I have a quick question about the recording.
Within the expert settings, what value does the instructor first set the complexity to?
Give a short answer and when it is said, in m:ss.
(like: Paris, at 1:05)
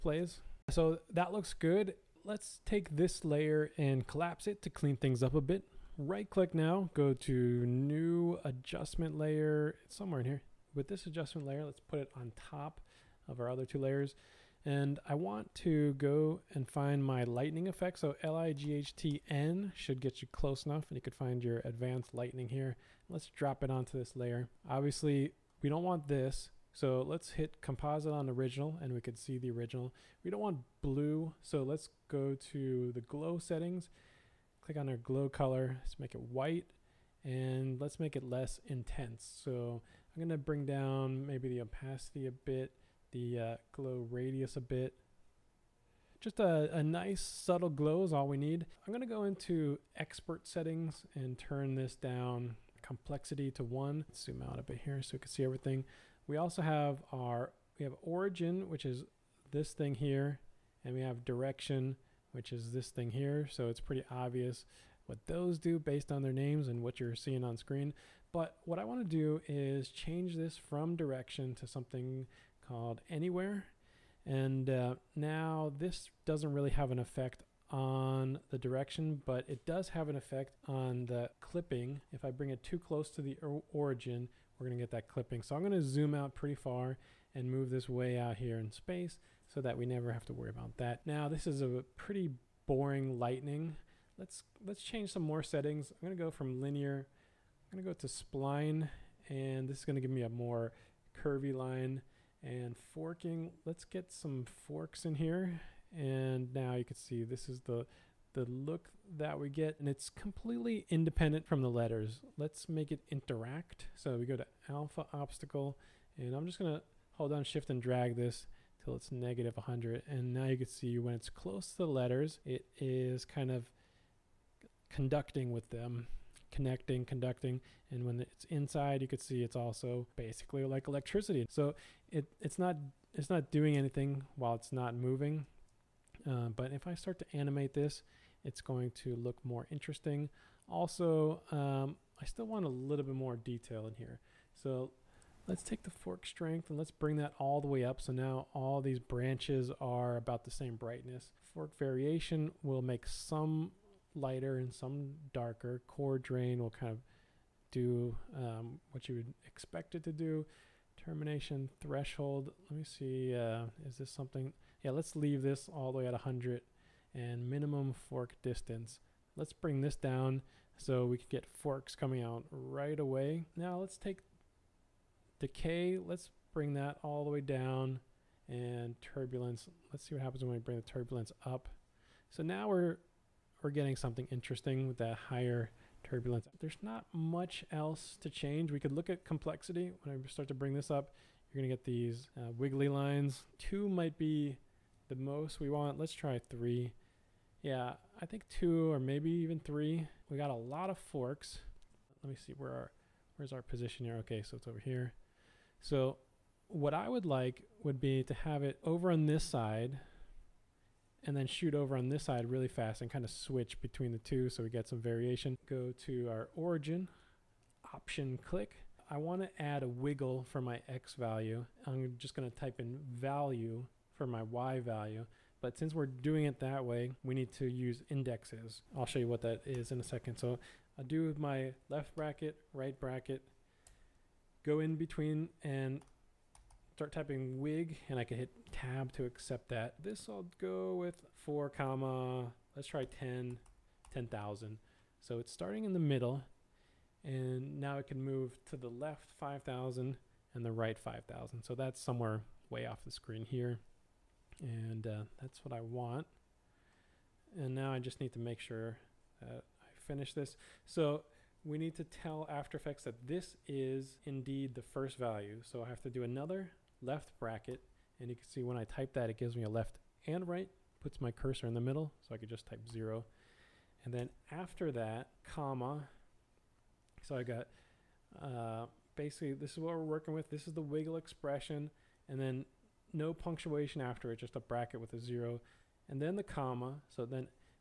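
1, at 0:53.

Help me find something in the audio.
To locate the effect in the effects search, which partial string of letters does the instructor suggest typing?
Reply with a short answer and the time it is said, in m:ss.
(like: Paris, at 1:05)
LIGHTN, at 0:18.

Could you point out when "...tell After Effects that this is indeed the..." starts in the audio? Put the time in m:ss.
4:22.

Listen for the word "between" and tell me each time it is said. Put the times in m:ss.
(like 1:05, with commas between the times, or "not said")
3:33, 3:54.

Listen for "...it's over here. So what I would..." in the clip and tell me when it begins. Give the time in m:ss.
3:24.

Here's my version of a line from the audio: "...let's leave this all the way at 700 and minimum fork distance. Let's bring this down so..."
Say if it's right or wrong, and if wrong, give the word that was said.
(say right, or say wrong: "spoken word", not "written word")
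wrong: "100", not "700".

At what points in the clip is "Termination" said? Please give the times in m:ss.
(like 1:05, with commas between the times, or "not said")
2:40.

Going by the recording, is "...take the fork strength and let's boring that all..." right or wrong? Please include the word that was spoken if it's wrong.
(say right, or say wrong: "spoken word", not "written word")
wrong: "bring", not "boring".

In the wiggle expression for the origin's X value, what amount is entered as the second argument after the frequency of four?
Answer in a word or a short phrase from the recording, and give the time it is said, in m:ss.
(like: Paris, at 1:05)
10,000, at 4:04.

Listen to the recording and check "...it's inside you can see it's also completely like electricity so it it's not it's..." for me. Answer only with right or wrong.
wrong.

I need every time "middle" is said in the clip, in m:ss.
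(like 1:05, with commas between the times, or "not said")
4:06, 4:31.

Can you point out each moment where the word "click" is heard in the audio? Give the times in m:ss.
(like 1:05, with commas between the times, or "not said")
0:06, 0:34, 3:38.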